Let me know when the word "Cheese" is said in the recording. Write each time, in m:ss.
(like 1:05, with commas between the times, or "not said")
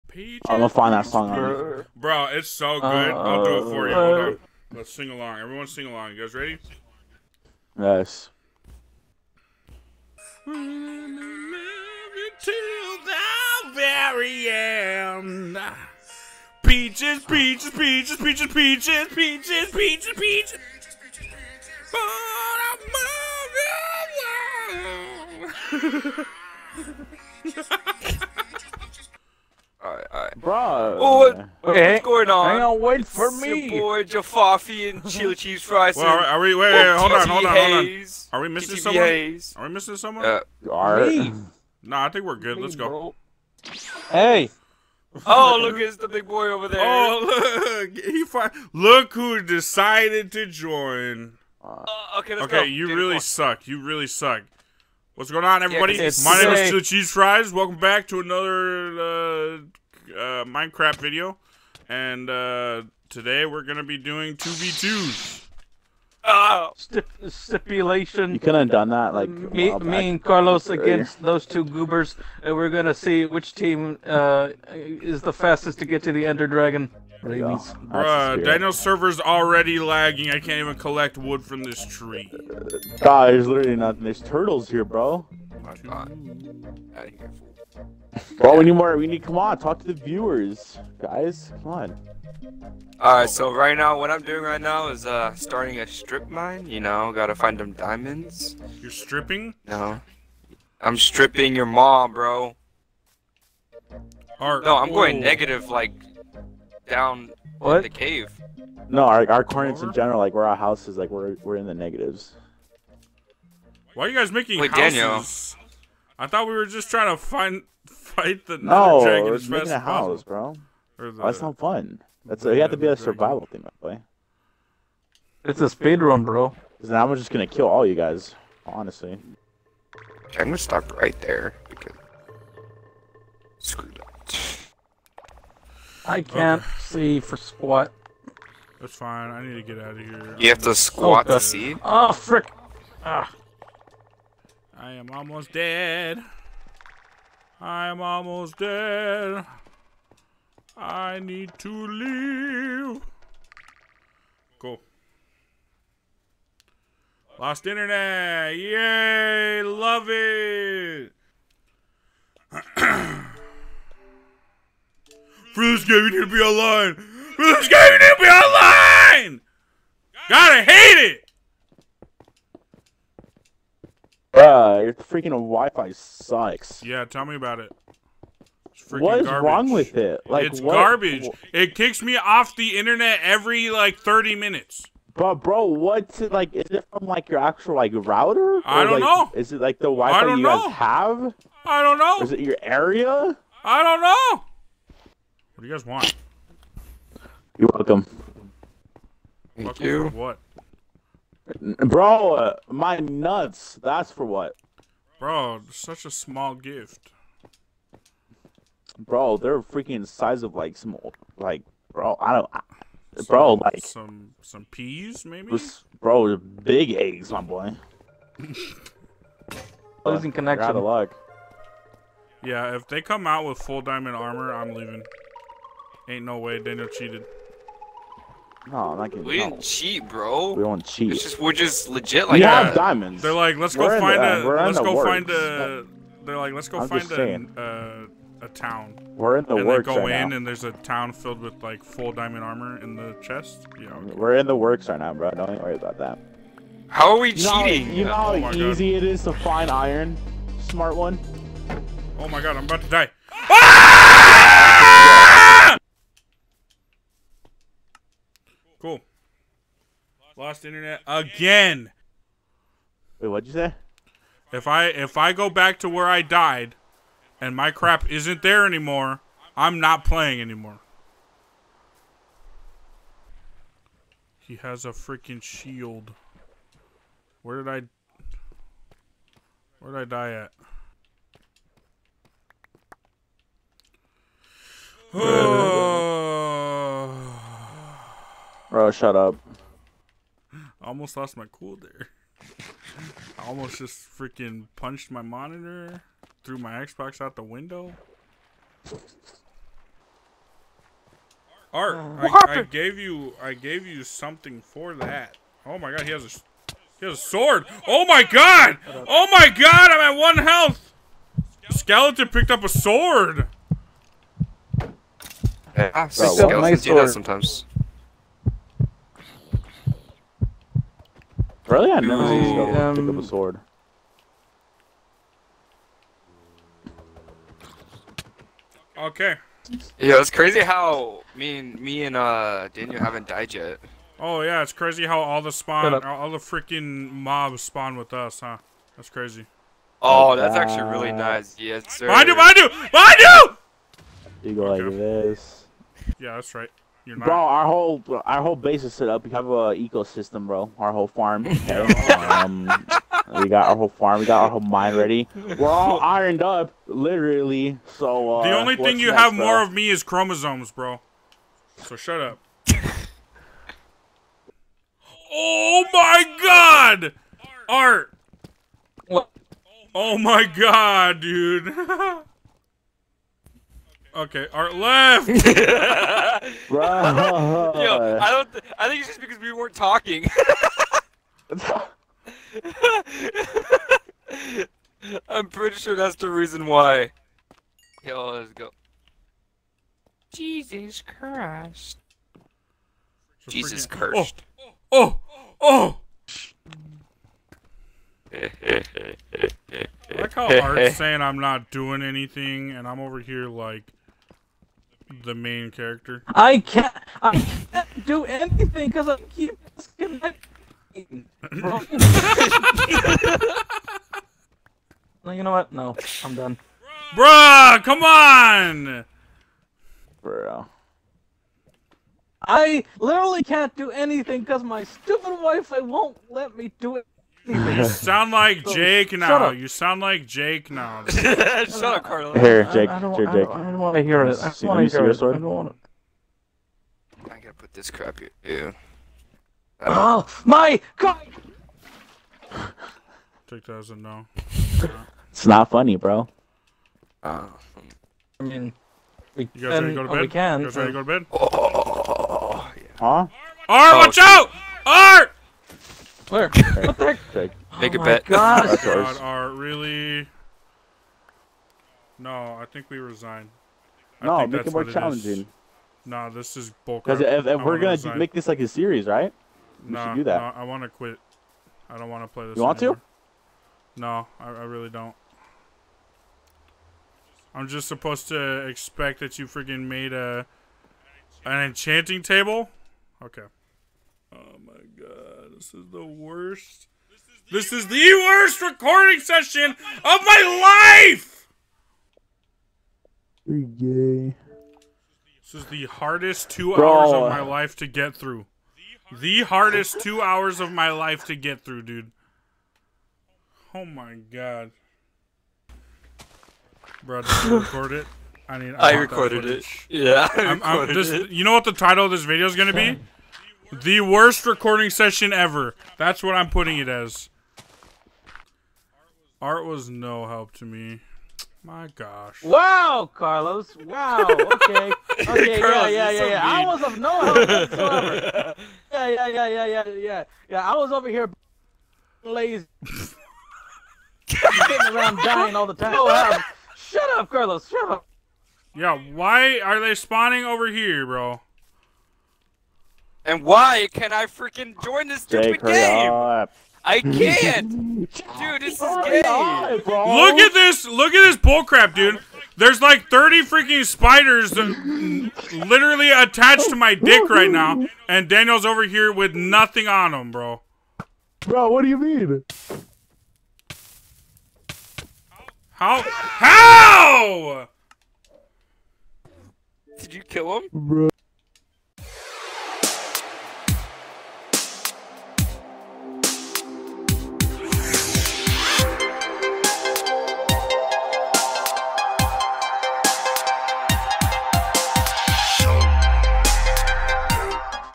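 0:35, 0:56.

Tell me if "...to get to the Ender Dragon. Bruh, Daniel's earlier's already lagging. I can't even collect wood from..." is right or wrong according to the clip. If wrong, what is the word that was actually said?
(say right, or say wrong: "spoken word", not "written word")
wrong: "server", not "earlier".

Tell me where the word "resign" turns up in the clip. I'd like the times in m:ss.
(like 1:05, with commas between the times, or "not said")
7:42, 7:47.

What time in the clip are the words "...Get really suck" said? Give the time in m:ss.
0:52.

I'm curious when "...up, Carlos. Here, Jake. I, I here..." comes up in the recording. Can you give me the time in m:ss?
7:11.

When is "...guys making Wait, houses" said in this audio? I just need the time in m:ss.
1:54.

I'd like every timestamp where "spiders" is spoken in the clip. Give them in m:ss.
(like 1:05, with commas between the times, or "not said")
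9:13.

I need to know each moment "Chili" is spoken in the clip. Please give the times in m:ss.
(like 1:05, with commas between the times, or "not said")
0:35, 0:56.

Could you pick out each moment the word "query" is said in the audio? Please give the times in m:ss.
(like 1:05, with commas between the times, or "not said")
not said.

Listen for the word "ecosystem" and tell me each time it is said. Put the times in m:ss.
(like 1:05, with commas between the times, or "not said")
5:49.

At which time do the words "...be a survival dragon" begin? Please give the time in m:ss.
2:02.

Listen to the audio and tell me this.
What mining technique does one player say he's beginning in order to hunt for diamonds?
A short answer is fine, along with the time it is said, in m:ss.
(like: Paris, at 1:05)
strip mine, at 1:35.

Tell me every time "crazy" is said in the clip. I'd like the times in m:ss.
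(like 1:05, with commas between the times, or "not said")
5:30, 5:34, 5:39.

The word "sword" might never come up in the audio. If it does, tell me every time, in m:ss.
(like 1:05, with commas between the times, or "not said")
5:07, 5:12, 5:23.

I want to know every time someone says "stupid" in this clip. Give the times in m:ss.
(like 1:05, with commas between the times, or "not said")
7:04, 9:05.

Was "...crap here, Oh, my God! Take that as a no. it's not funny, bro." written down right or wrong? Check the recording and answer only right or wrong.
right.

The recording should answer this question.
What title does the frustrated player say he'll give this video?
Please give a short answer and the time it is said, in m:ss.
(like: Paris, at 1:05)
The worst recording session ever, at 8:33.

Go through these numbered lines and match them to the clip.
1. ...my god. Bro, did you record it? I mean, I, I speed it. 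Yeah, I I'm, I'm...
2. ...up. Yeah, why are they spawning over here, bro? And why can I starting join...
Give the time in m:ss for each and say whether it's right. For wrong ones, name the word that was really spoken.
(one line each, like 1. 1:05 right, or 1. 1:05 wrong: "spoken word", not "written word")
1. 8:23 wrong: "recorded", not "speed"
2. 8:57 wrong: "freaking", not "starting".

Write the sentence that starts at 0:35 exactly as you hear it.
well, are, we, wait, wait, hold on, hold on, hold on.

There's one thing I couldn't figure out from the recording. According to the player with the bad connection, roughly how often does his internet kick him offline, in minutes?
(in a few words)
30.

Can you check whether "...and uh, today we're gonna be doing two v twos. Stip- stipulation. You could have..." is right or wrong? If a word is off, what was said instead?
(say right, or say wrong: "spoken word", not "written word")
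right.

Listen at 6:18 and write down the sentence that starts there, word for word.
Th I think it's just because we weren't talking.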